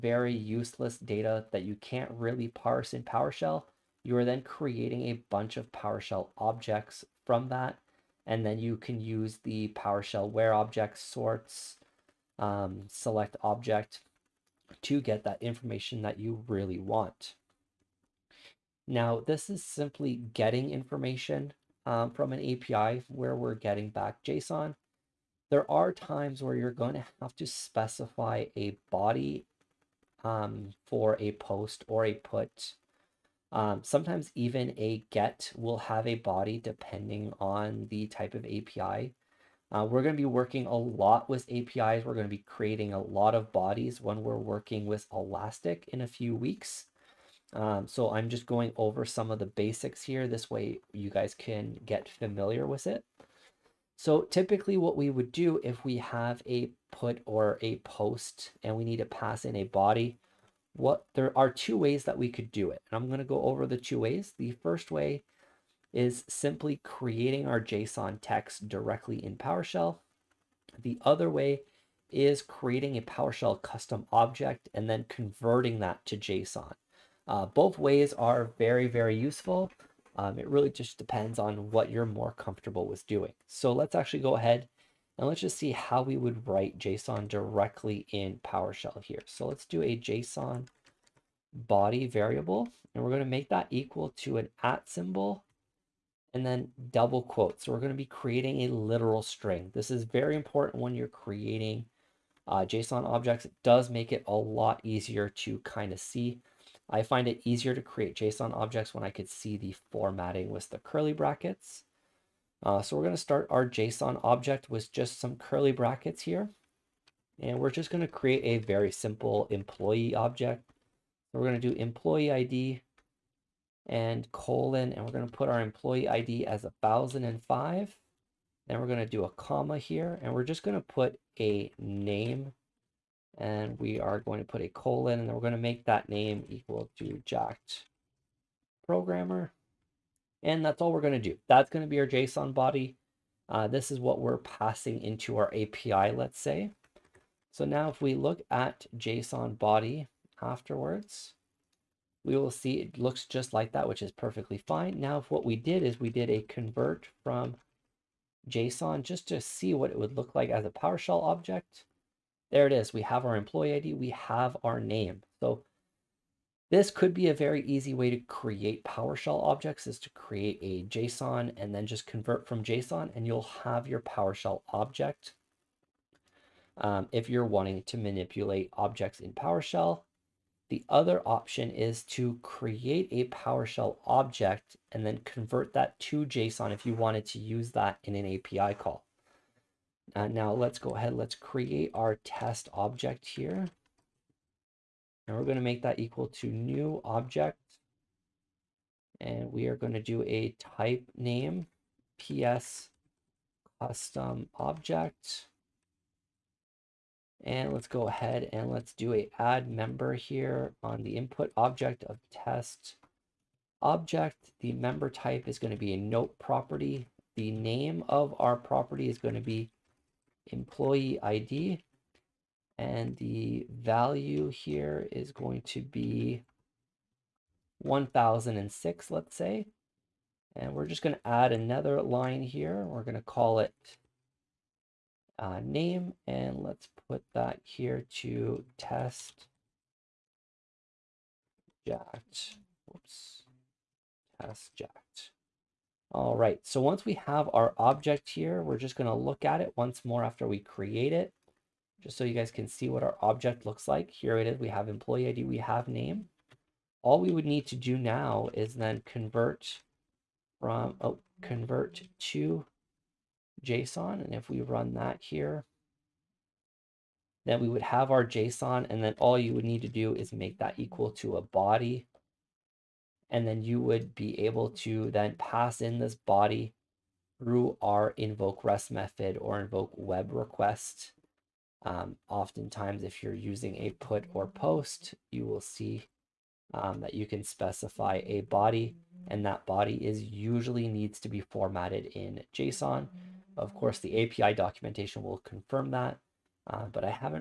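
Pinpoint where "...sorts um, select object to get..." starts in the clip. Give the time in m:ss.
0:10.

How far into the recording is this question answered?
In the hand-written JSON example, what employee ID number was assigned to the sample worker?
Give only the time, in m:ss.
2:06.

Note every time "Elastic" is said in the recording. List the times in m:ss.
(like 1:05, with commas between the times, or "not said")
0:45.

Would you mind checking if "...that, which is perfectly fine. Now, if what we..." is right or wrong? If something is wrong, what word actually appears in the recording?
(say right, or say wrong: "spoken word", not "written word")
right.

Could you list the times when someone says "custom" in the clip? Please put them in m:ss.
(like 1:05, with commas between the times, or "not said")
1:13, 3:23.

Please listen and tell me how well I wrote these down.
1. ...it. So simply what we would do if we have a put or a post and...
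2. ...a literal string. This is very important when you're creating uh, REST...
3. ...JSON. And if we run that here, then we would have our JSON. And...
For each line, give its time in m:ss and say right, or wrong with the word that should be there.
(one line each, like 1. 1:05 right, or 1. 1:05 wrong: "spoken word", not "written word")
1. 0:52 wrong: "typically", not "simply"
2. 1:38 wrong: "JSON", not "REST"
3. 4:23 right.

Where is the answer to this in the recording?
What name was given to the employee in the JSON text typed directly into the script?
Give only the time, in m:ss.
2:17.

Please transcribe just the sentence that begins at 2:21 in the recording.
That's going to be our JSON body.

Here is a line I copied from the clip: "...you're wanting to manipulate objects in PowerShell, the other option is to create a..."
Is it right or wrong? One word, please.
right.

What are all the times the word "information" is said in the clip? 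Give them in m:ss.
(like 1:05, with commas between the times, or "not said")
0:15, 0:20.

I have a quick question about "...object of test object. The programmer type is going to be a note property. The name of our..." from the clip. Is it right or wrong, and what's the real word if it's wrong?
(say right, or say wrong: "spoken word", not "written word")
wrong: "member", not "programmer".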